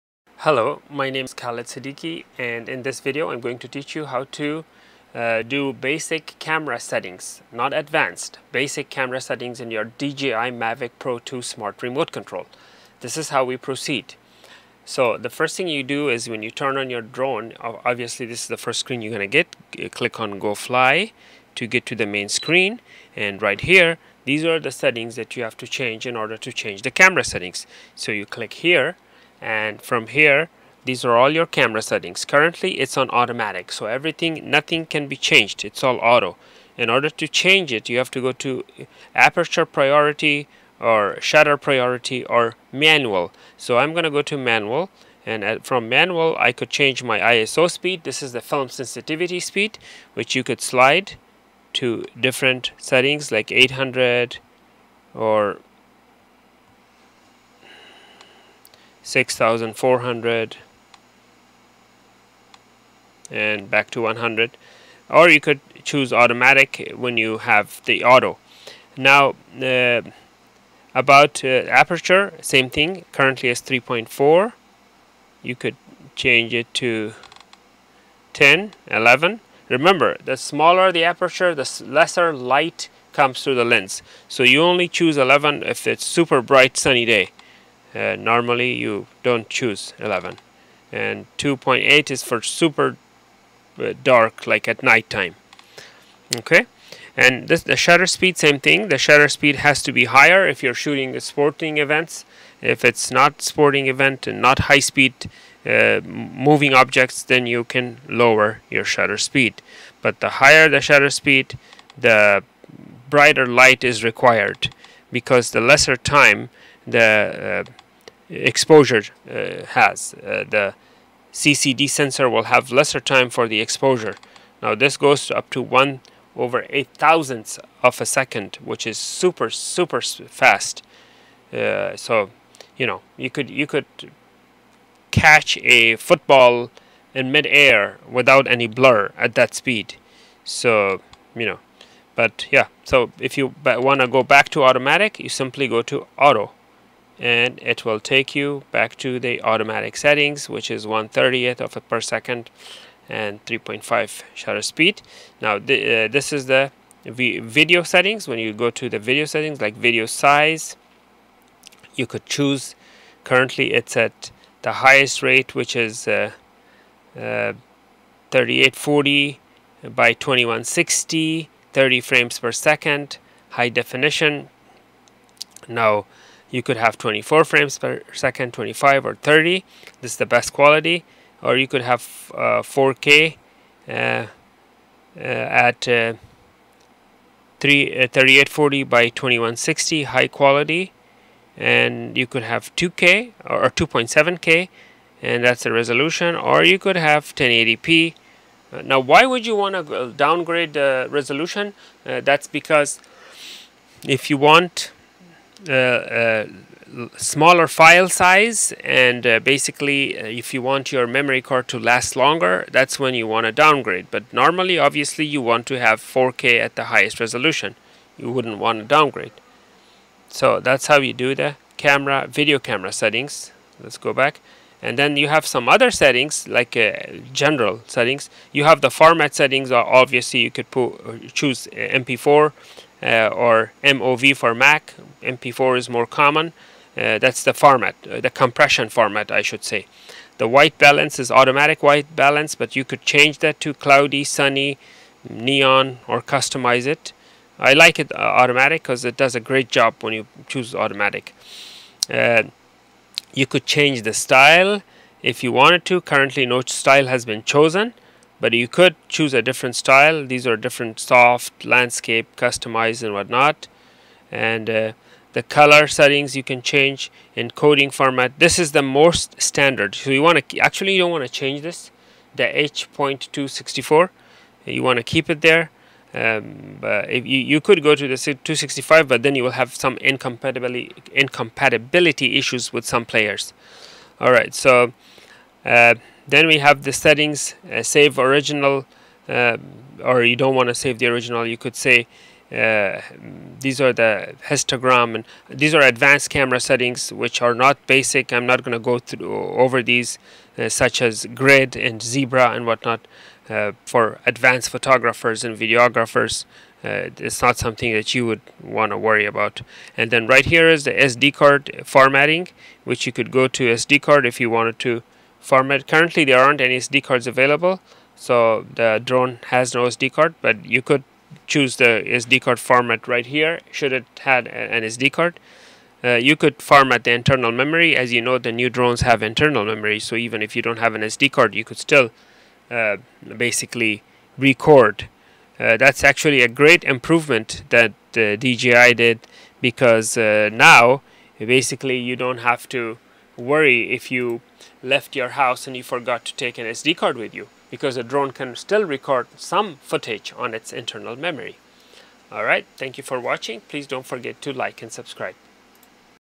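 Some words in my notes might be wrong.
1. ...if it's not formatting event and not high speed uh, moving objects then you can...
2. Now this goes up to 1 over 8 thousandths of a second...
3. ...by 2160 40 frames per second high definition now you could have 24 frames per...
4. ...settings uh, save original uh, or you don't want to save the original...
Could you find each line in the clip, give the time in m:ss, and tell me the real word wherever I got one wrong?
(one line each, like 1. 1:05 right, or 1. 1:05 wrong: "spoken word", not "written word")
1. 1:42 wrong: "sporting", not "formatting"
2. 2:04 right
3. 2:50 wrong: "30", not "40"
4. 4:46 right.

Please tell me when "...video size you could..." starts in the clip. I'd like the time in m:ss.
2:39.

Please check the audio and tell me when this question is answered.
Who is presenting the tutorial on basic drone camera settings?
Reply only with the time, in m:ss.
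0:01.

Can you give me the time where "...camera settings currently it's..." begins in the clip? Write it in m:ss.
0:31.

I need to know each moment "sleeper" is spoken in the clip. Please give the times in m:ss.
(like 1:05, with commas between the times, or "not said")
not said.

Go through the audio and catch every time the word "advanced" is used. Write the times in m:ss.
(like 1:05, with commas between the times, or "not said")
0:07, 4:55, 5:04.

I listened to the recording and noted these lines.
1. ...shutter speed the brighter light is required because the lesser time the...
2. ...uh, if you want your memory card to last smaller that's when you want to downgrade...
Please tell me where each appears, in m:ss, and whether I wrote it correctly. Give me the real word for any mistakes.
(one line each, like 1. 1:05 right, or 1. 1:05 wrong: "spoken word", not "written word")
1. 1:50 right
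2. 3:30 wrong: "longer", not "smaller".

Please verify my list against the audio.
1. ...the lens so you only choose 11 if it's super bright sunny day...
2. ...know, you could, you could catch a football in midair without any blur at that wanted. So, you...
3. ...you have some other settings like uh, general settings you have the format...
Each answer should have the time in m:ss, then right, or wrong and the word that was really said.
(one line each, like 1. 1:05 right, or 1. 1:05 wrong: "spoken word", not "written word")
1. 1:23 right
2. 2:12 wrong: "speed", not "wanted"
3. 3:45 right.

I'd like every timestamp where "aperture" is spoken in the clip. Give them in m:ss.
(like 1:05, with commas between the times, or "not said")
0:39, 1:11, 1:21.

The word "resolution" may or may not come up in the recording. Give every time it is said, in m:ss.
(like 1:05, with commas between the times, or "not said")
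3:15, 3:21, 3:37.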